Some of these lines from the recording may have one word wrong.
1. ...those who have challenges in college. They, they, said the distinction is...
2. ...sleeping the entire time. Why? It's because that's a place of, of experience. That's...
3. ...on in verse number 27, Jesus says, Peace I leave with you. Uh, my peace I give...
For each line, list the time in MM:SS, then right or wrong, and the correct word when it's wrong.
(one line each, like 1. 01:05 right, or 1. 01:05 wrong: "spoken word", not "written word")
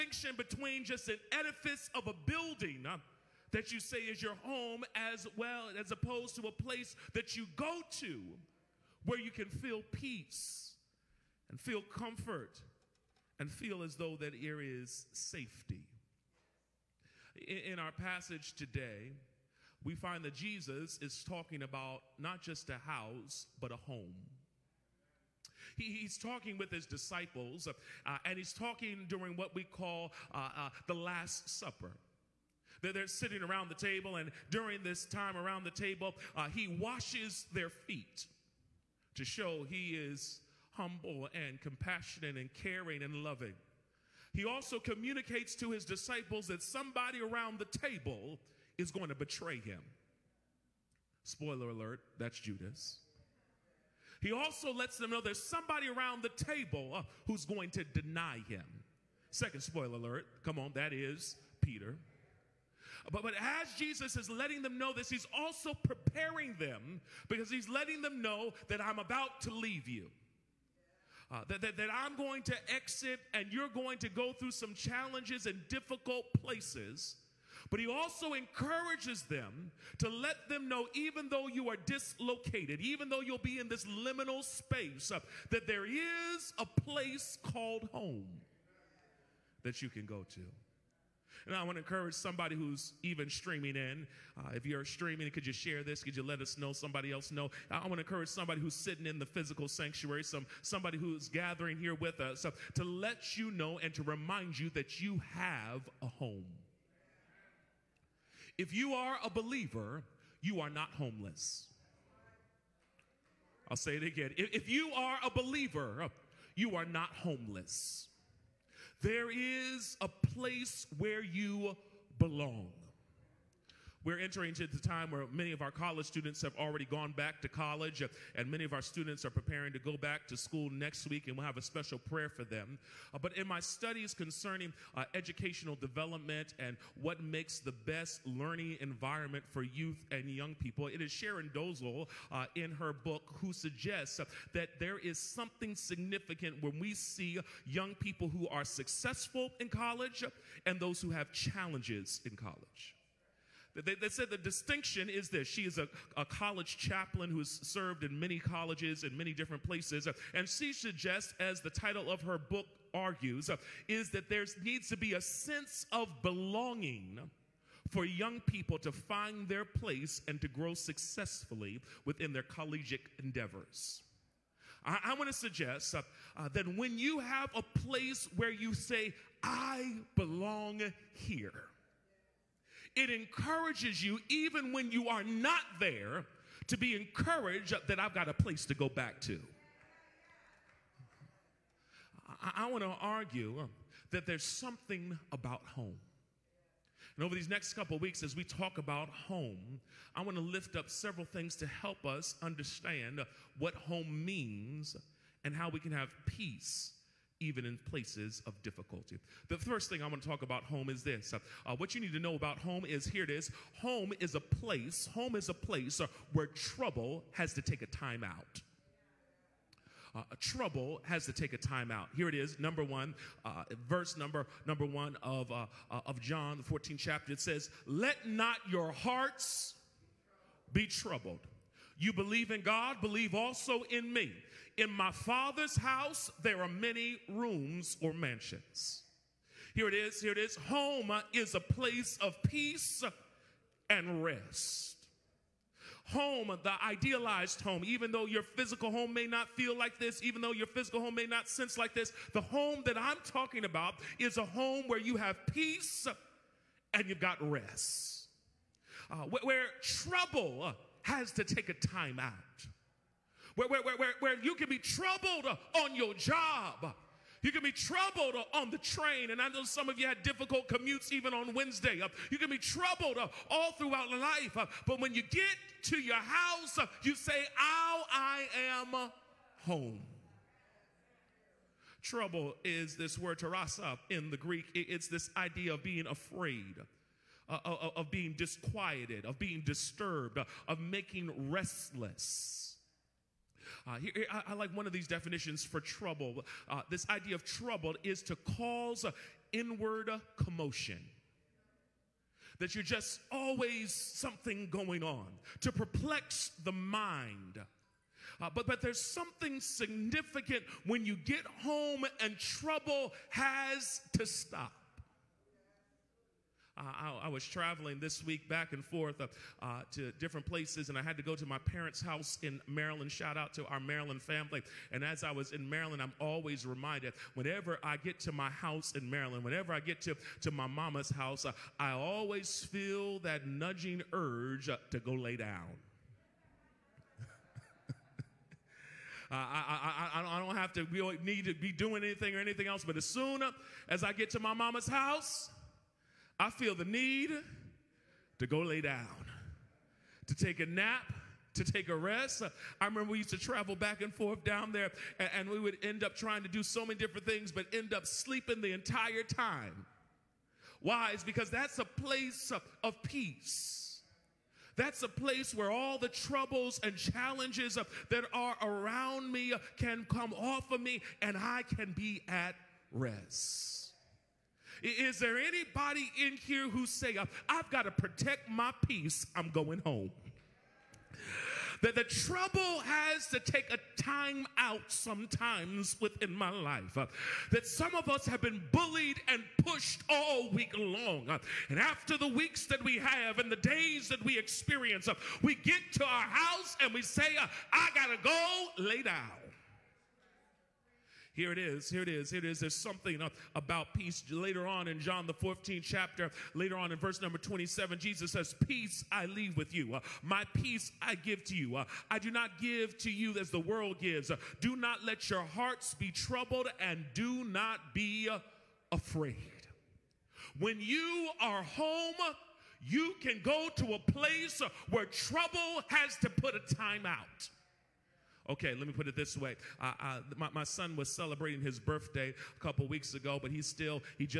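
1. 02:30 right
2. 05:58 wrong: "peace", not "experience"
3. 06:46 right.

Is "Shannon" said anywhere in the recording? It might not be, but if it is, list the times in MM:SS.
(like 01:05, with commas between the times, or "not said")
not said.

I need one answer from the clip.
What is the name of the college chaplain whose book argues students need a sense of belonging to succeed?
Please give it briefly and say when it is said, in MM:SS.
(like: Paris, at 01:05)
Sharon Dozel, at 02:21.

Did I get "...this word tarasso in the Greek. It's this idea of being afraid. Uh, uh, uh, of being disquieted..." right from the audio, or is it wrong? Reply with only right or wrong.
right.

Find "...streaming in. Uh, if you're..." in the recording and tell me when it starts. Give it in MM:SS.
01:33.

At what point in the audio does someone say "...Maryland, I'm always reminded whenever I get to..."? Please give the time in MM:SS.
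05:25.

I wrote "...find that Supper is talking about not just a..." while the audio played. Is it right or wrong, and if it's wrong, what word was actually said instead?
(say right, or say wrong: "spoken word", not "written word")
wrong: "Jesus", not "Supper".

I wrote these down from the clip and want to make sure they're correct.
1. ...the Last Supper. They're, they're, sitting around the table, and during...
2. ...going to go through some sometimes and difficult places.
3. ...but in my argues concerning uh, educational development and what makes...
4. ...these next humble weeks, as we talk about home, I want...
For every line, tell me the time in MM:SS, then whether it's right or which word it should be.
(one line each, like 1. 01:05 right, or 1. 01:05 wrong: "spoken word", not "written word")
1. 00:30 right
2. 01:13 wrong: "challenges", not "sometimes"
3. 02:13 wrong: "studies", not "argues"
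4. 03:17 wrong: "couple", not "humble".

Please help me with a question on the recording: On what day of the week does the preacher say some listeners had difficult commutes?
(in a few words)
Wednesday.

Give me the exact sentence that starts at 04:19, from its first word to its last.
Uh, where, where trouble has to take a time out.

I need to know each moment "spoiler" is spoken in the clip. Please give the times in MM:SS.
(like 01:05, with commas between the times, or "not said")
00:51, 00:59.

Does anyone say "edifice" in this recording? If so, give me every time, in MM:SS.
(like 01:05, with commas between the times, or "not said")
00:01.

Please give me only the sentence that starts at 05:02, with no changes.
That you're just always something going on, to perplex the mind.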